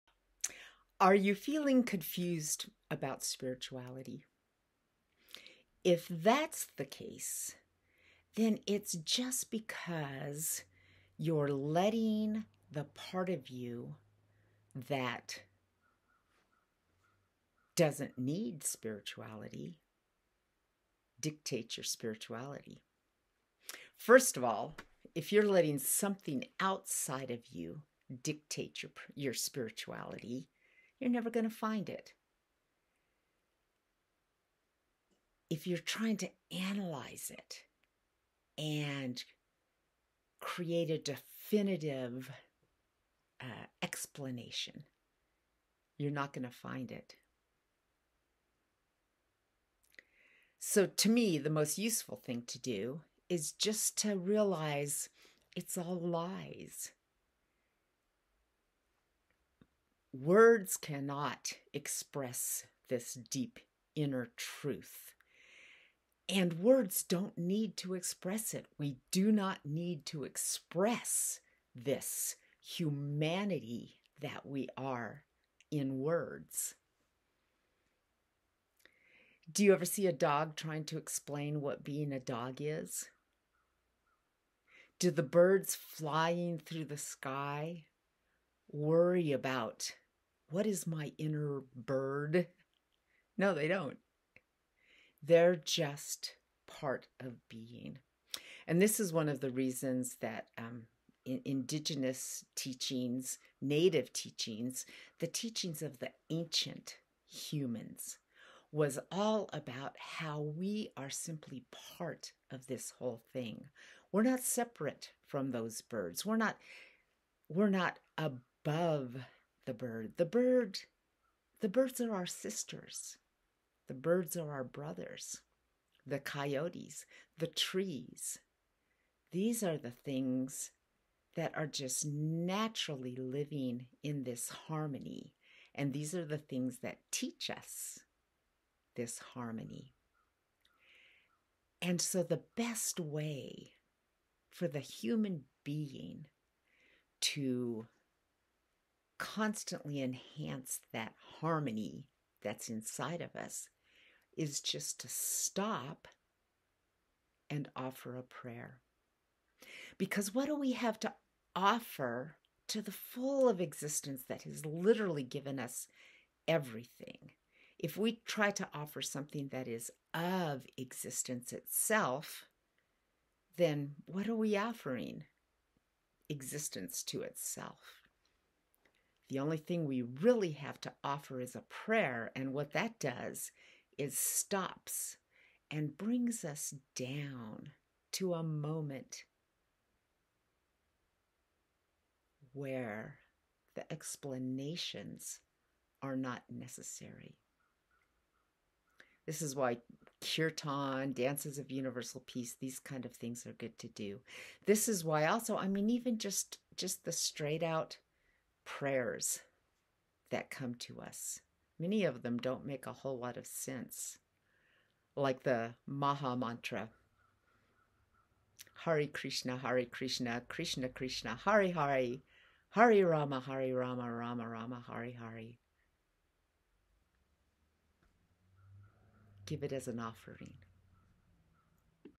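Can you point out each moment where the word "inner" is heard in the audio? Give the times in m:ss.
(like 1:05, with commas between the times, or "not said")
1:03, 1:31.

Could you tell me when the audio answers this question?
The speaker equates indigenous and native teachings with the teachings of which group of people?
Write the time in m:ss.
1:46.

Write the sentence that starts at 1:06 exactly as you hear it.
And words don't need to express it.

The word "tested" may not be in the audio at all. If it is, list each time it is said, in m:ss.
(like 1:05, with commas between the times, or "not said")
not said.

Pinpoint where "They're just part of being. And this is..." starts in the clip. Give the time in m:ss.
1:35.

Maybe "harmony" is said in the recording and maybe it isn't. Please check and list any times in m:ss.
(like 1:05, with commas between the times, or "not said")
2:14, 2:19, 2:31.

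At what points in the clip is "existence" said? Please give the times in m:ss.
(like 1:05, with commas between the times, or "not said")
2:43, 2:50, 2:56.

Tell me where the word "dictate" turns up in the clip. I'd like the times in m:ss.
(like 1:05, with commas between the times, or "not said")
0:21, 0:28.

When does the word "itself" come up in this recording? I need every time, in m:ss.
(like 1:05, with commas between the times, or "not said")
2:51, 2:57.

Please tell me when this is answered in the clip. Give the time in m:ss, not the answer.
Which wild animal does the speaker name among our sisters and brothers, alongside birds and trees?
2:06.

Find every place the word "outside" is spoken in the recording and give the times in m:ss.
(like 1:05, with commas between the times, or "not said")
0:26.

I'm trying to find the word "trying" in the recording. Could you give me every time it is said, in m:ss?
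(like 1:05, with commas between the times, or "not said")
0:35, 1:20.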